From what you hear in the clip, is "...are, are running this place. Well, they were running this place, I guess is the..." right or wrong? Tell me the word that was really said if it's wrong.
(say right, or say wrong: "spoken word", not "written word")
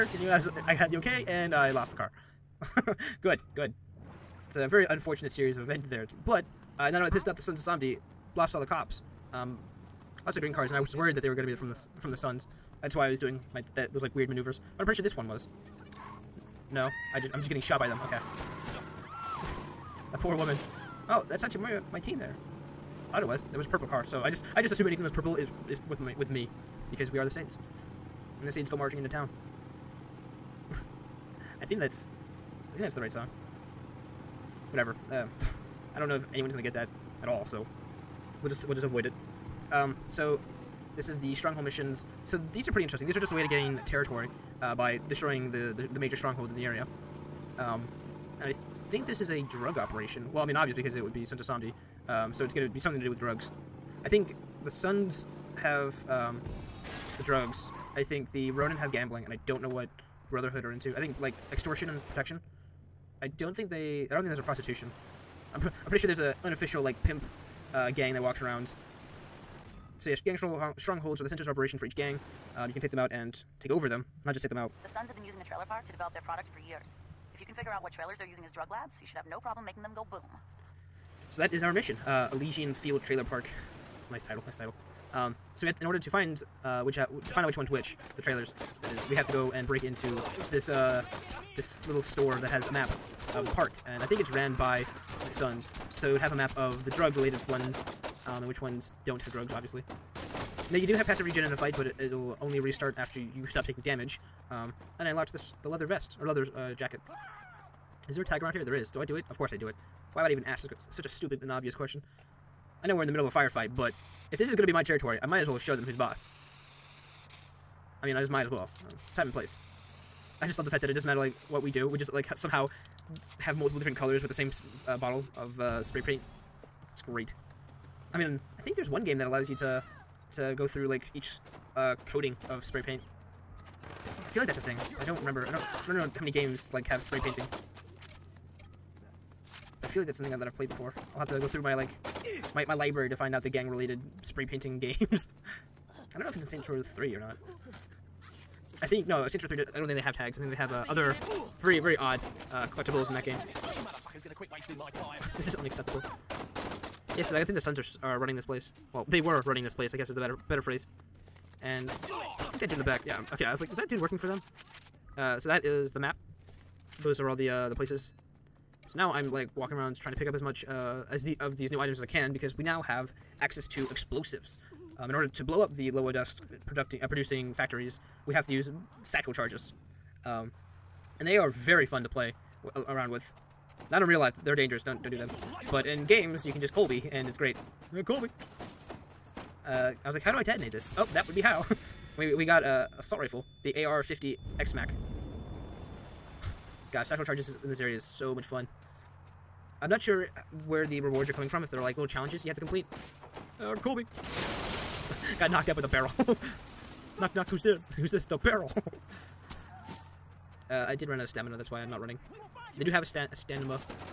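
right.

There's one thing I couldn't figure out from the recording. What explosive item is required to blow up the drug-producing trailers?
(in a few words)
Satchel charges.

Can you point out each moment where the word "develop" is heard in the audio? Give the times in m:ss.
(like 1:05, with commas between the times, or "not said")
1:15.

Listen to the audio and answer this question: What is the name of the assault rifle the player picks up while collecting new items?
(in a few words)
AR-50 XMAC.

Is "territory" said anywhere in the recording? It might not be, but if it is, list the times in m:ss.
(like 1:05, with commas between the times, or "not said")
0:43, 1:54.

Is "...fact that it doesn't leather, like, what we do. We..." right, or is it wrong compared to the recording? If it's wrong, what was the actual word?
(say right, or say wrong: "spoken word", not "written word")
wrong: "matter", not "leather".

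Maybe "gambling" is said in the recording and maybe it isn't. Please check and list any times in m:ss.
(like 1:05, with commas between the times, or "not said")
0:58.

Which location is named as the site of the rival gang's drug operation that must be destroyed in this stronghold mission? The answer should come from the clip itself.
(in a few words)
Elysian Field Trailer Park.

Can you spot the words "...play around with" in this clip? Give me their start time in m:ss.
3:02.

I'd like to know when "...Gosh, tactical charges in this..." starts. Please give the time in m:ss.
3:16.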